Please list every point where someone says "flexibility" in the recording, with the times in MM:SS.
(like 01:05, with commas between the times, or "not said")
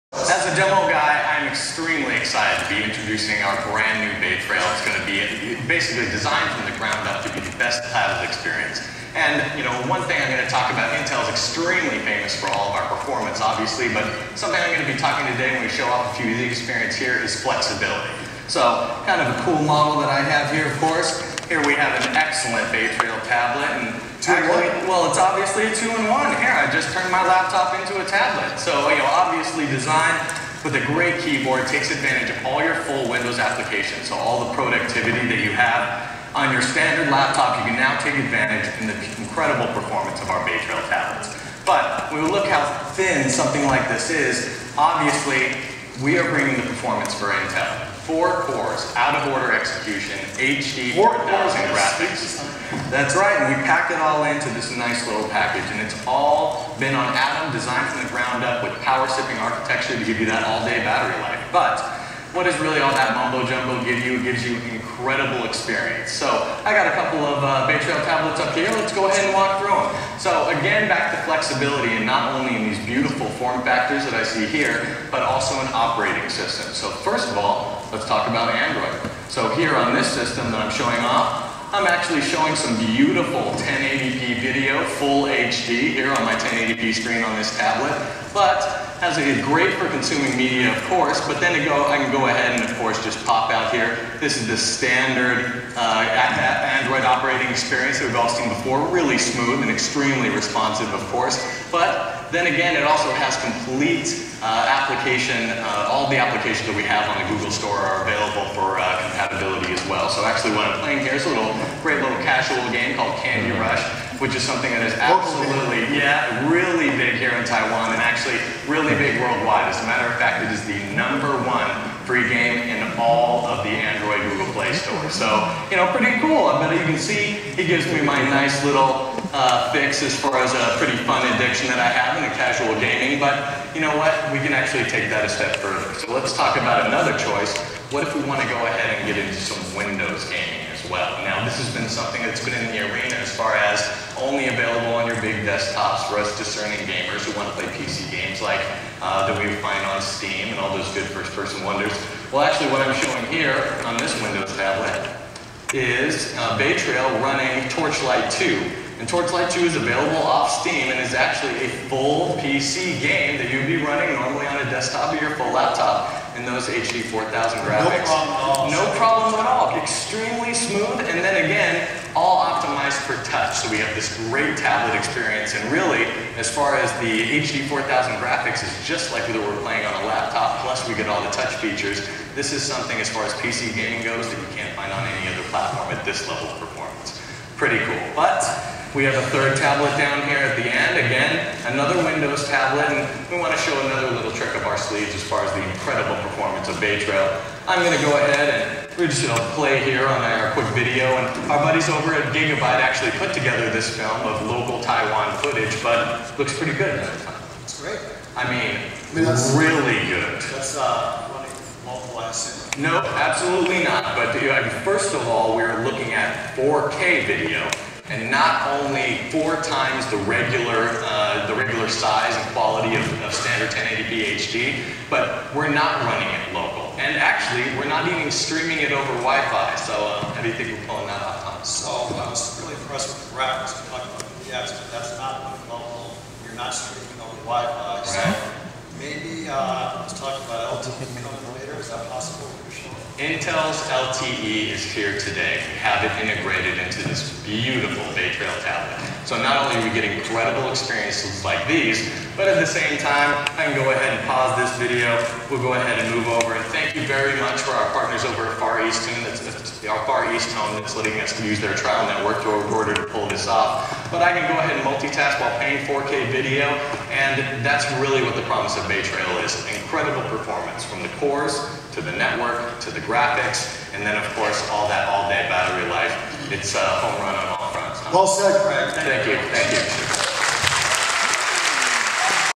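00:17, 01:11.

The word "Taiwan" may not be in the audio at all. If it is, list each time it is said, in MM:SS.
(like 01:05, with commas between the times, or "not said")
01:57, 03:24.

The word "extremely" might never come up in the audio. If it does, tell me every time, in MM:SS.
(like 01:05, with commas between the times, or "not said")
00:01, 00:11, 01:39, 02:49.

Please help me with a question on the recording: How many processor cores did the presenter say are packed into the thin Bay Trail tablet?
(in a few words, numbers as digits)
4.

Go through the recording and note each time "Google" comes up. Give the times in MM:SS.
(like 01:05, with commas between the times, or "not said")
01:47, 02:04.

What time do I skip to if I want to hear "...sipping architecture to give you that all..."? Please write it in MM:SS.
00:59.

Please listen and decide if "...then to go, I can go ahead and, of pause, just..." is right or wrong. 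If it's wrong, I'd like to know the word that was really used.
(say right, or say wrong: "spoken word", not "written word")
wrong: "course", not "pause".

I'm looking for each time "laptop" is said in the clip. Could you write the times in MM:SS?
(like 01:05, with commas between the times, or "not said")
00:27, 00:37, 02:45, 03:00.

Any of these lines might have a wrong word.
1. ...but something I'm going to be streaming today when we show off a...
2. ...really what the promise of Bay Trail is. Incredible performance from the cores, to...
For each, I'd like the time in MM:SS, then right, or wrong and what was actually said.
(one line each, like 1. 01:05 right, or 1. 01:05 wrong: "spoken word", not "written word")
1. 00:13 wrong: "talking", not "streaming"
2. 04:28 right.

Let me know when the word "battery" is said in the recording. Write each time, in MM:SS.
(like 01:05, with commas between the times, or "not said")
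01:00, 04:35.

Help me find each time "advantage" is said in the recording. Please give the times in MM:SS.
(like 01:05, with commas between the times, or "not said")
00:31, 00:38.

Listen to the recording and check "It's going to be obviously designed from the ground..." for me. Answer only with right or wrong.
wrong.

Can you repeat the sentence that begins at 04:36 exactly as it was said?
It's a home run on all well said, Craig.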